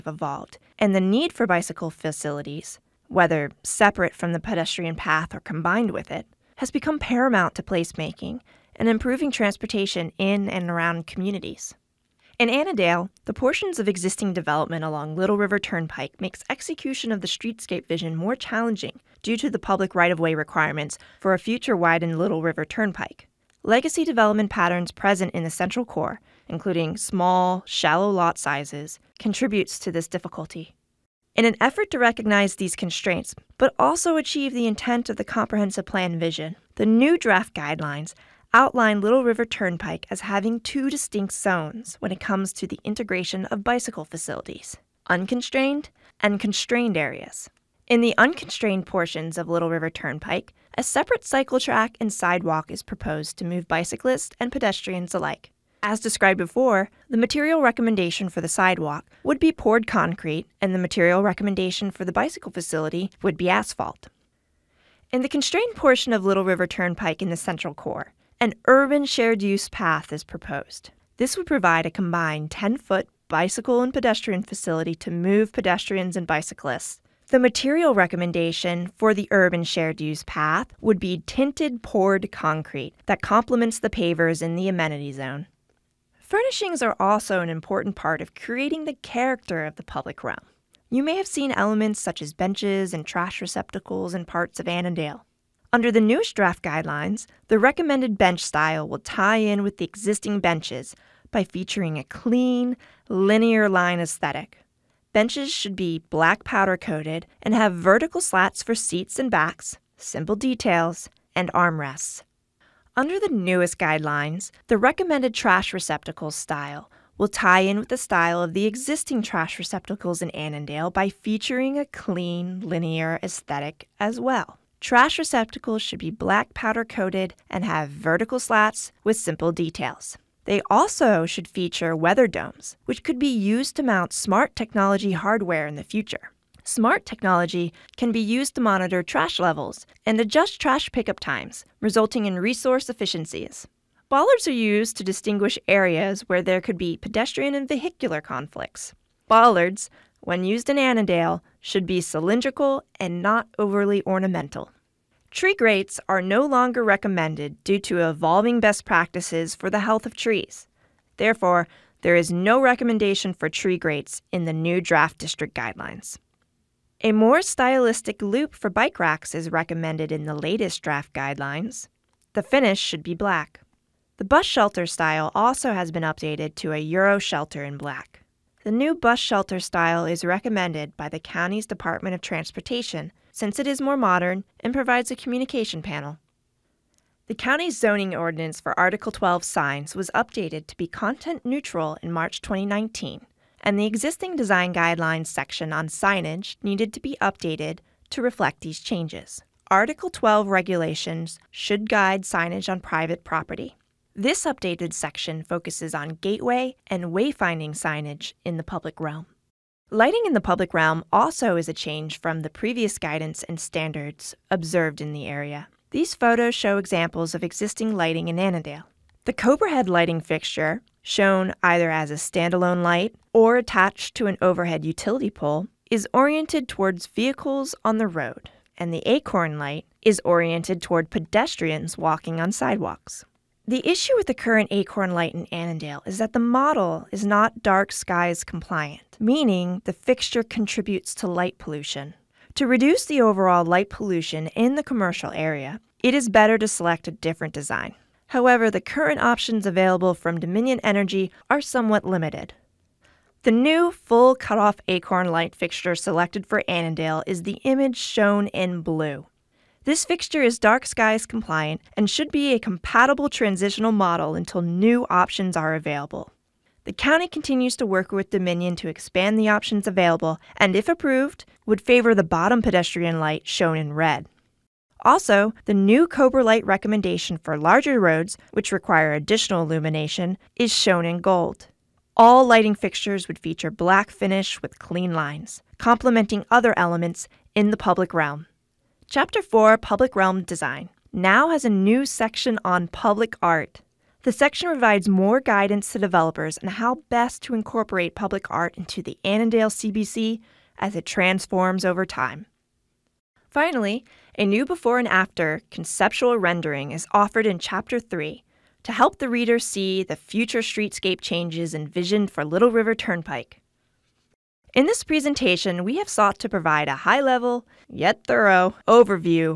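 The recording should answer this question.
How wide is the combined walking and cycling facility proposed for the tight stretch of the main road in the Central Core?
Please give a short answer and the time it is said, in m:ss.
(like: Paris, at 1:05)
10 foot, at 1:12.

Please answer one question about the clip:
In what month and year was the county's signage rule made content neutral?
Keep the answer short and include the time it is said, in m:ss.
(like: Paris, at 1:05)
March 2019, at 3:12.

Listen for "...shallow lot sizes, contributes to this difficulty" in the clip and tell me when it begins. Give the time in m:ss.
0:27.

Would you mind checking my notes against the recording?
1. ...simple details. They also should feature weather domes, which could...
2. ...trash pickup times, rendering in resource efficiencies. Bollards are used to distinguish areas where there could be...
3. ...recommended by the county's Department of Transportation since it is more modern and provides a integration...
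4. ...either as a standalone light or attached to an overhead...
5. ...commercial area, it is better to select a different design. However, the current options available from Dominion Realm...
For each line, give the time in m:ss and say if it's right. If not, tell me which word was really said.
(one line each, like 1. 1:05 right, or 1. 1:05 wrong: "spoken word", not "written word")
1. 2:09 right
2. 2:20 wrong: "resulting", not "rendering"
3. 3:00 wrong: "communication", not "integration"
4. 3:41 right
5. 4:04 wrong: "Energy", not "Realm".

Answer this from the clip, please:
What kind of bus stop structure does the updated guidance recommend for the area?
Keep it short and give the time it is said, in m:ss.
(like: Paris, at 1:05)
Euro shelter, at 2:56.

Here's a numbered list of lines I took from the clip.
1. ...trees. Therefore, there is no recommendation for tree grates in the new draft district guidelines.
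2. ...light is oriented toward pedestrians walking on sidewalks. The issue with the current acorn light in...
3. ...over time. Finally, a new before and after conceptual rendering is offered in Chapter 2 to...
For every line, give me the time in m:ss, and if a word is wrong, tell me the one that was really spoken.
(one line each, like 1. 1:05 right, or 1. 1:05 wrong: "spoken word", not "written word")
1. 2:40 right
2. 3:49 right
3. 5:01 wrong: "3", not "2".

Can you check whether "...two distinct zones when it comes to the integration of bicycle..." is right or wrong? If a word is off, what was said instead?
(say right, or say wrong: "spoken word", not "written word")
right.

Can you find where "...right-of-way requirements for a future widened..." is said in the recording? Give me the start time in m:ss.
0:19.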